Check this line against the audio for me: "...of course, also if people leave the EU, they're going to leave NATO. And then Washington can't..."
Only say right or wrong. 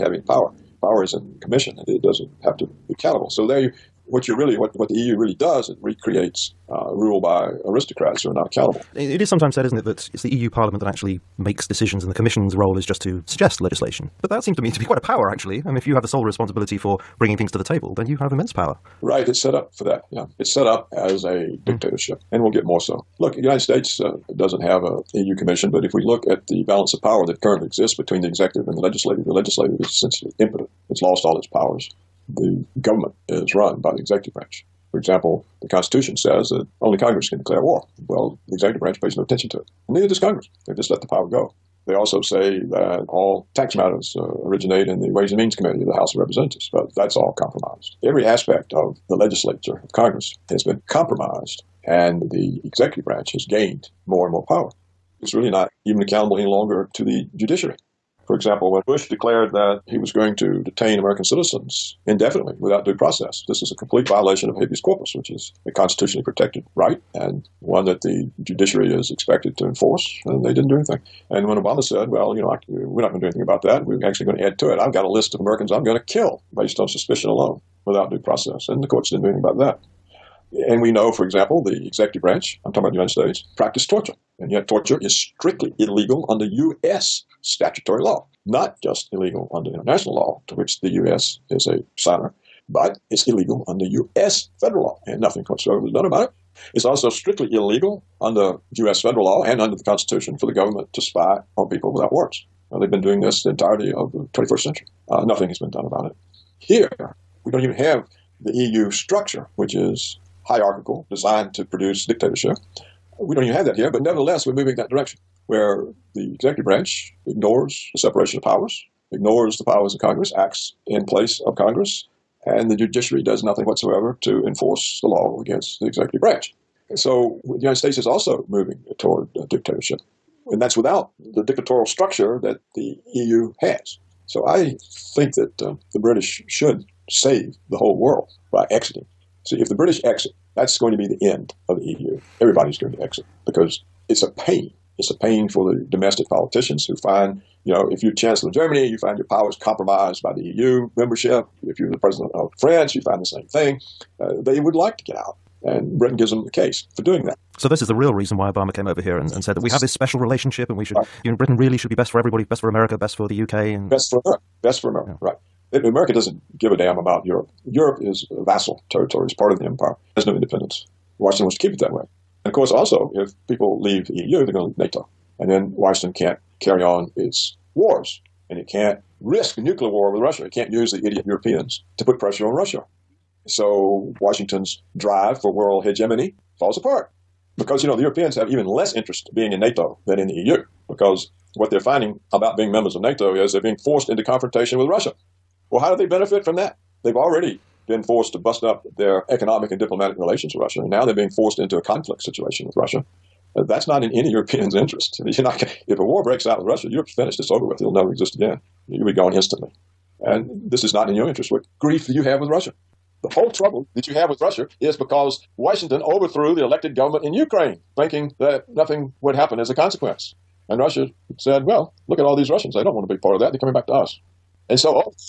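right.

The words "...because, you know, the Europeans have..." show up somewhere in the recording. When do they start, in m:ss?
3:07.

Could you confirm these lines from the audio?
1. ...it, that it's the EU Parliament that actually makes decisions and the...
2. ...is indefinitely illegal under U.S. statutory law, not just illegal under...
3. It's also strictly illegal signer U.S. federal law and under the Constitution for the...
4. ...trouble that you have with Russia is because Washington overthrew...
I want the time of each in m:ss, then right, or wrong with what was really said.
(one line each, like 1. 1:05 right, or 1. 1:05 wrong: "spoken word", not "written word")
1. 0:09 right
2. 1:24 wrong: "strictly", not "indefinitely"
3. 1:36 wrong: "under", not "signer"
4. 3:33 right.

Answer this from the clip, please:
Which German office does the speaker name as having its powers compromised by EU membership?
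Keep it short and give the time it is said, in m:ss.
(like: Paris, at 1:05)
Chancellor of Germany, at 2:28.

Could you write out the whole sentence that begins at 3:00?
It can't use the idiot Europeans to put pressure on Russia.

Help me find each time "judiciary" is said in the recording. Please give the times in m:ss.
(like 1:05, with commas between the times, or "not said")
0:57, 1:08, 2:02.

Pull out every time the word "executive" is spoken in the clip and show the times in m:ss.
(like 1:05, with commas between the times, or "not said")
0:28, 0:33, 0:38, 0:52, 1:21, 1:56, 2:05.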